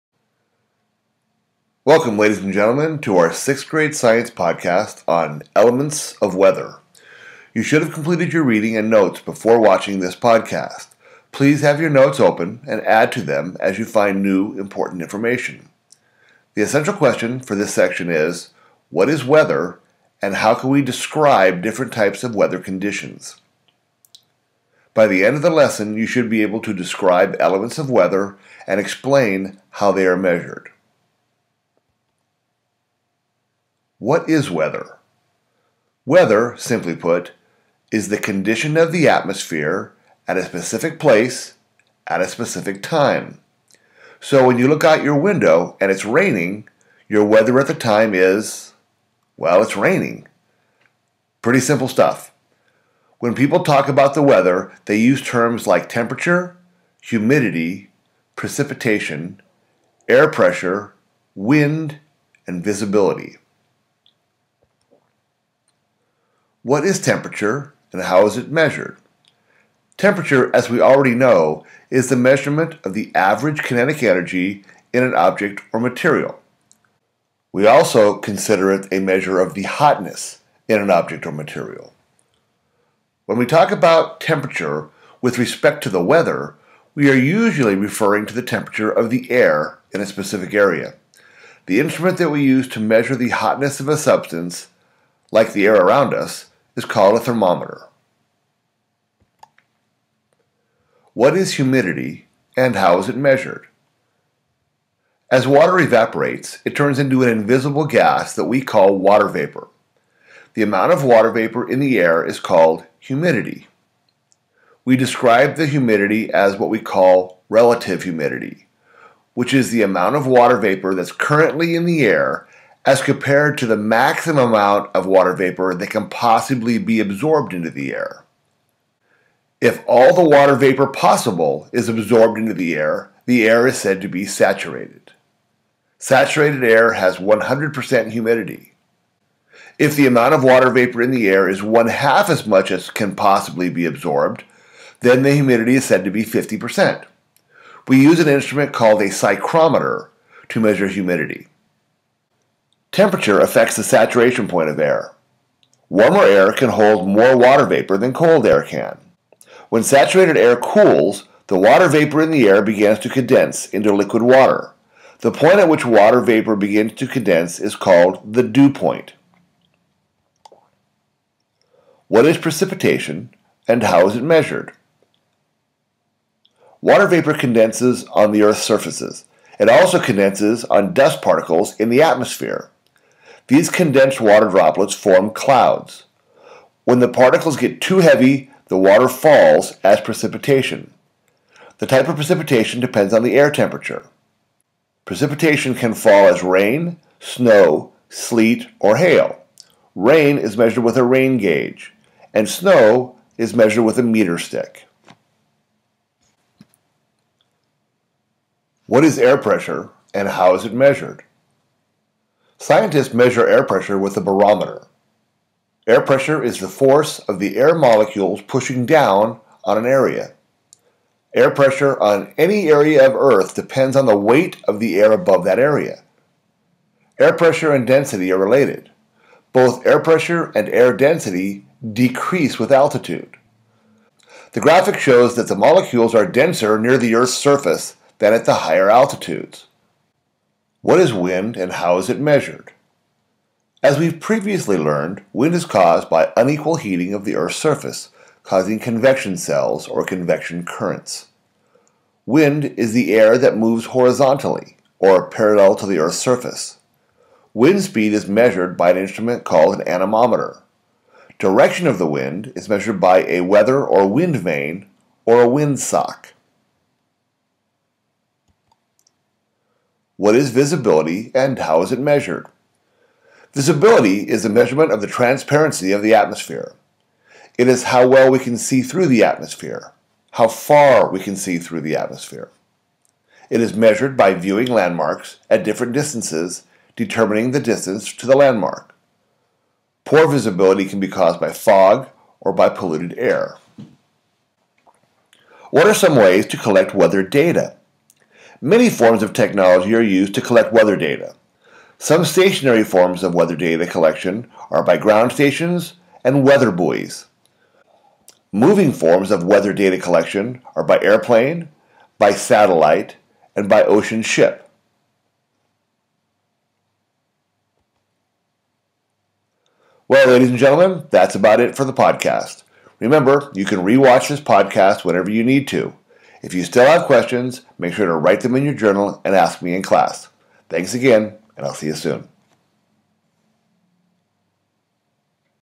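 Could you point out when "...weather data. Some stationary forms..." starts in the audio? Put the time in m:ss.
5:00.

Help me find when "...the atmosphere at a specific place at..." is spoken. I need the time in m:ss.
0:38.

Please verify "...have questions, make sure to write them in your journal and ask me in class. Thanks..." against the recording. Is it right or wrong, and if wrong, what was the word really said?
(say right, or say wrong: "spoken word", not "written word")
right.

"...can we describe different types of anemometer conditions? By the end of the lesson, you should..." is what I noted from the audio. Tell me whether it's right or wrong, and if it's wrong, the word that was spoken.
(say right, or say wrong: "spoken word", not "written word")
wrong: "weather", not "anemometer".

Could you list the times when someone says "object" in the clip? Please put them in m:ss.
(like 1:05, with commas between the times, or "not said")
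1:15, 1:20.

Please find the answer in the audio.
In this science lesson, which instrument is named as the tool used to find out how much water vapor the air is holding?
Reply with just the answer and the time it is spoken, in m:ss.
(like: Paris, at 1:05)
psychrometer, at 2:29.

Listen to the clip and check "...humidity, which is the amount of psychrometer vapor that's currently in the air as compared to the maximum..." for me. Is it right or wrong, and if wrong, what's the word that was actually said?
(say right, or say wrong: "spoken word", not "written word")
wrong: "water", not "psychrometer".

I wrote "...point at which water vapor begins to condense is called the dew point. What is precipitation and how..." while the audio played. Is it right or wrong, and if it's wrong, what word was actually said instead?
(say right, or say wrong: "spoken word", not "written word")
right.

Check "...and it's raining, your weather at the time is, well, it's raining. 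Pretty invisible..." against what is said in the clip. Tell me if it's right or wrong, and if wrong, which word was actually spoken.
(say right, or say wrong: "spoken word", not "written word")
wrong: "simple", not "invisible".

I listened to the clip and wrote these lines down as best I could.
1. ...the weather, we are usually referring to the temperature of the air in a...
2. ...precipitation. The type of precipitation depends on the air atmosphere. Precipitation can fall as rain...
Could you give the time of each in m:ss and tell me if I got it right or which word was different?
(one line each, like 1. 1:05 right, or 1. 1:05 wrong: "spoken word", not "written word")
1. 1:25 right
2. 3:09 wrong: "temperature", not "atmosphere".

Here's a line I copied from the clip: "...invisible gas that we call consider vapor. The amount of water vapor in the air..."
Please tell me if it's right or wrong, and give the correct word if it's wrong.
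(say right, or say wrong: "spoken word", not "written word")
wrong: "water", not "consider".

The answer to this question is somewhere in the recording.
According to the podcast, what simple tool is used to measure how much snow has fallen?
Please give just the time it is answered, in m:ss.
3:24.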